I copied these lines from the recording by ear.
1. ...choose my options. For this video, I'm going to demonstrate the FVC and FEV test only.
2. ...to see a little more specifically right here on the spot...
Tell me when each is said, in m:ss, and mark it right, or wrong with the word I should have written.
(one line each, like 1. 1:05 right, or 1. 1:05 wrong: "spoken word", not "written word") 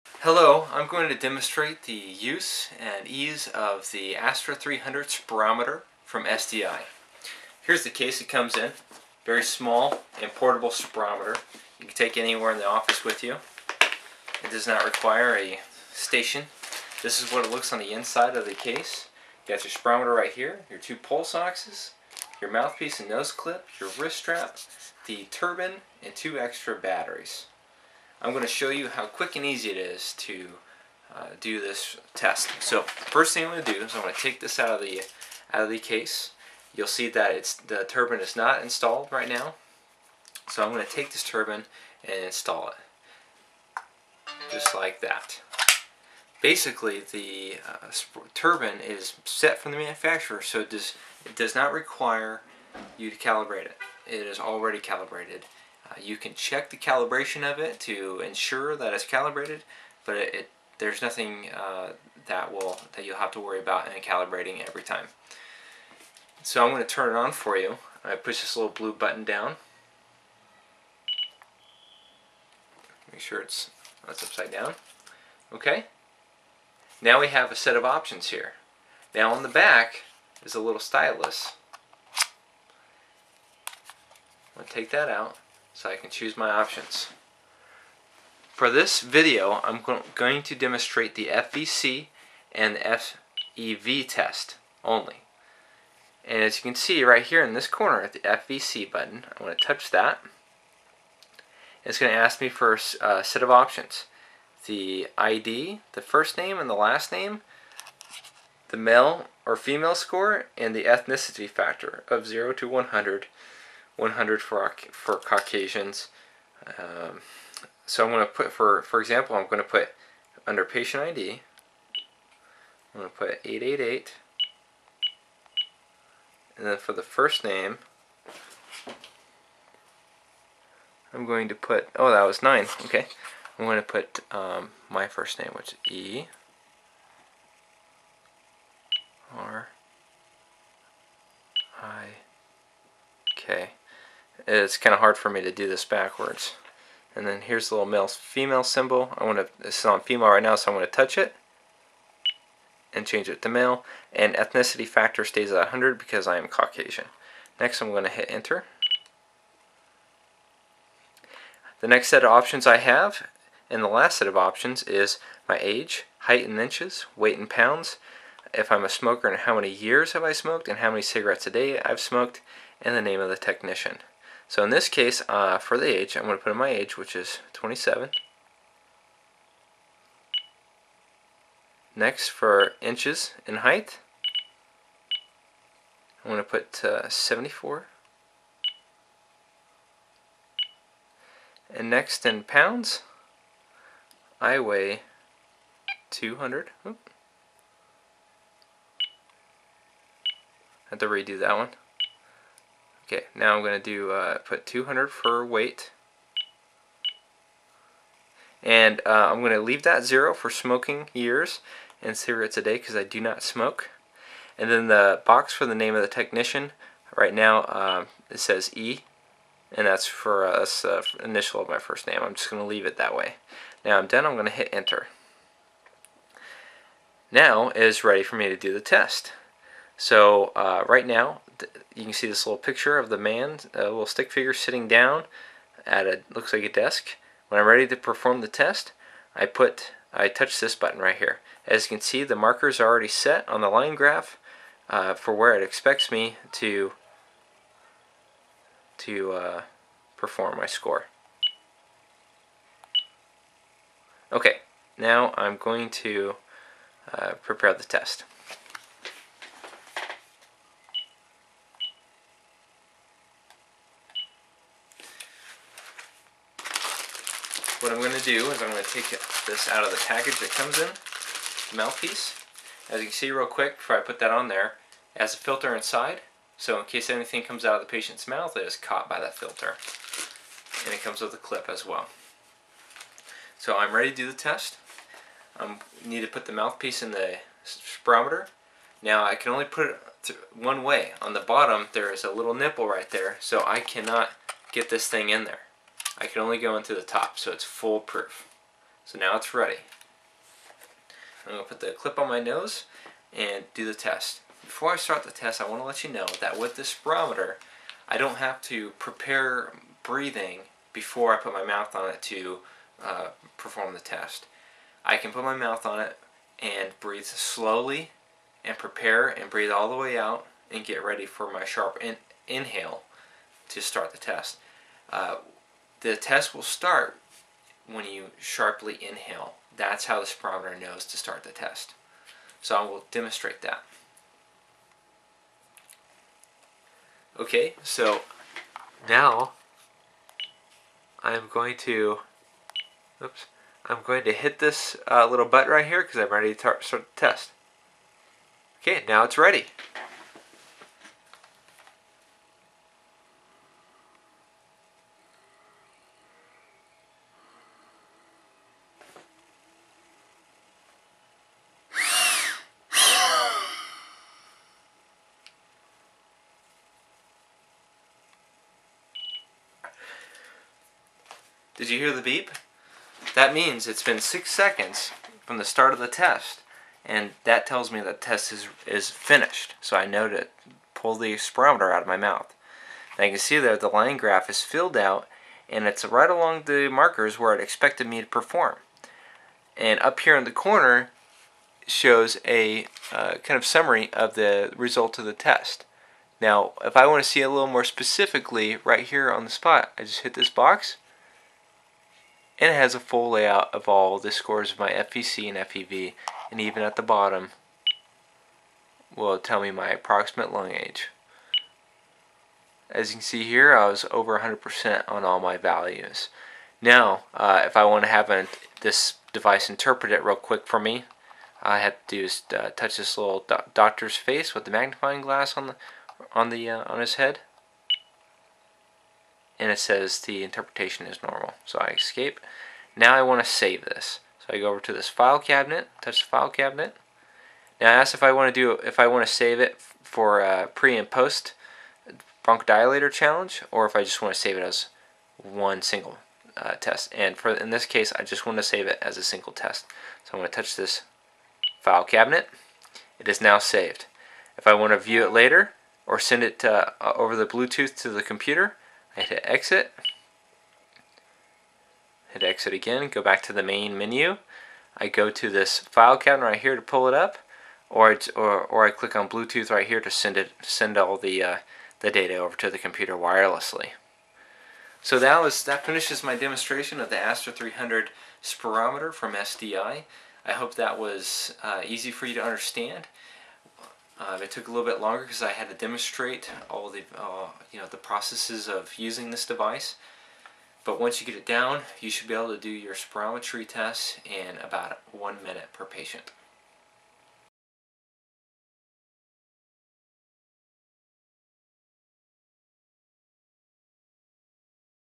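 1. 1:26 right
2. 6:37 right.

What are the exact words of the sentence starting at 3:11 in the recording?
And next in pounds, I weigh 200.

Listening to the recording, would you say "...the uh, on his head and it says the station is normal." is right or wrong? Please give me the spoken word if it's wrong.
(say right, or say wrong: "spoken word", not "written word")
wrong: "interpretation", not "station".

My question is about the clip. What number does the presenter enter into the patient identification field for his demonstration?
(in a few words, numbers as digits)
888.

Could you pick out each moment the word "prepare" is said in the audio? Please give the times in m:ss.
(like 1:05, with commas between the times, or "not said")
4:17, 5:08, 5:18.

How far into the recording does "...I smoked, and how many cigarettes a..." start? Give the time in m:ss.
2:50.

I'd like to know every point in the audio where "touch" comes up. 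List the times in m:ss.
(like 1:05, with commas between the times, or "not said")
1:39, 2:30, 4:00, 7:02, 7:16, 7:30.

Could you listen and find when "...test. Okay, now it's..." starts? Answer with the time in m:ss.
5:47.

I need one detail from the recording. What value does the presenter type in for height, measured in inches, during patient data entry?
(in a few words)
74.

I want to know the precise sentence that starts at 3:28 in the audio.
And uh, I'm going to leave that zero for smoking years and cigarettes a day because I do not smoke.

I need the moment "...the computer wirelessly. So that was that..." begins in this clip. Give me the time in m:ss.
7:52.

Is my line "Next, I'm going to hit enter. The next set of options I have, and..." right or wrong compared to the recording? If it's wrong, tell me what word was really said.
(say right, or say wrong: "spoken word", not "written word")
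right.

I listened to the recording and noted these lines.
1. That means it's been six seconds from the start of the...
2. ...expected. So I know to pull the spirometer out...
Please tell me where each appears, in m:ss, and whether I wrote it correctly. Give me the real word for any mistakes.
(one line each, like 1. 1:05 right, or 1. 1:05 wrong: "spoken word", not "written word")
1. 6:13 right
2. 6:19 wrong: "finished", not "expected".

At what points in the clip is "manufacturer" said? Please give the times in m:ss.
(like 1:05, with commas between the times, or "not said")
0:49.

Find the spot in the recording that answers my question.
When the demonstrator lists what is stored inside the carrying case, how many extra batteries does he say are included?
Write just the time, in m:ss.
0:26.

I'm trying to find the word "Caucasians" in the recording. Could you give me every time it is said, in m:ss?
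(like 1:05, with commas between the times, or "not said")
1:55, 2:36.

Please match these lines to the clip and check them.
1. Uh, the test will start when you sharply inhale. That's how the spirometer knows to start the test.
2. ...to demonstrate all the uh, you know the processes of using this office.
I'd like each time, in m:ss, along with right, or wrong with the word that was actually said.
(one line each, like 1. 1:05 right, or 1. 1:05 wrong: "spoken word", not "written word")
1. 5:25 right
2. 8:05 wrong: "device", not "office".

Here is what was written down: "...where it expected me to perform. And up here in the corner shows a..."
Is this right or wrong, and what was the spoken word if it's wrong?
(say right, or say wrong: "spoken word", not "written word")
right.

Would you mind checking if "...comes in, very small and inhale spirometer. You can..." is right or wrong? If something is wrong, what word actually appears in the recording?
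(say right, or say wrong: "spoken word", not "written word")
wrong: "portable", not "inhale".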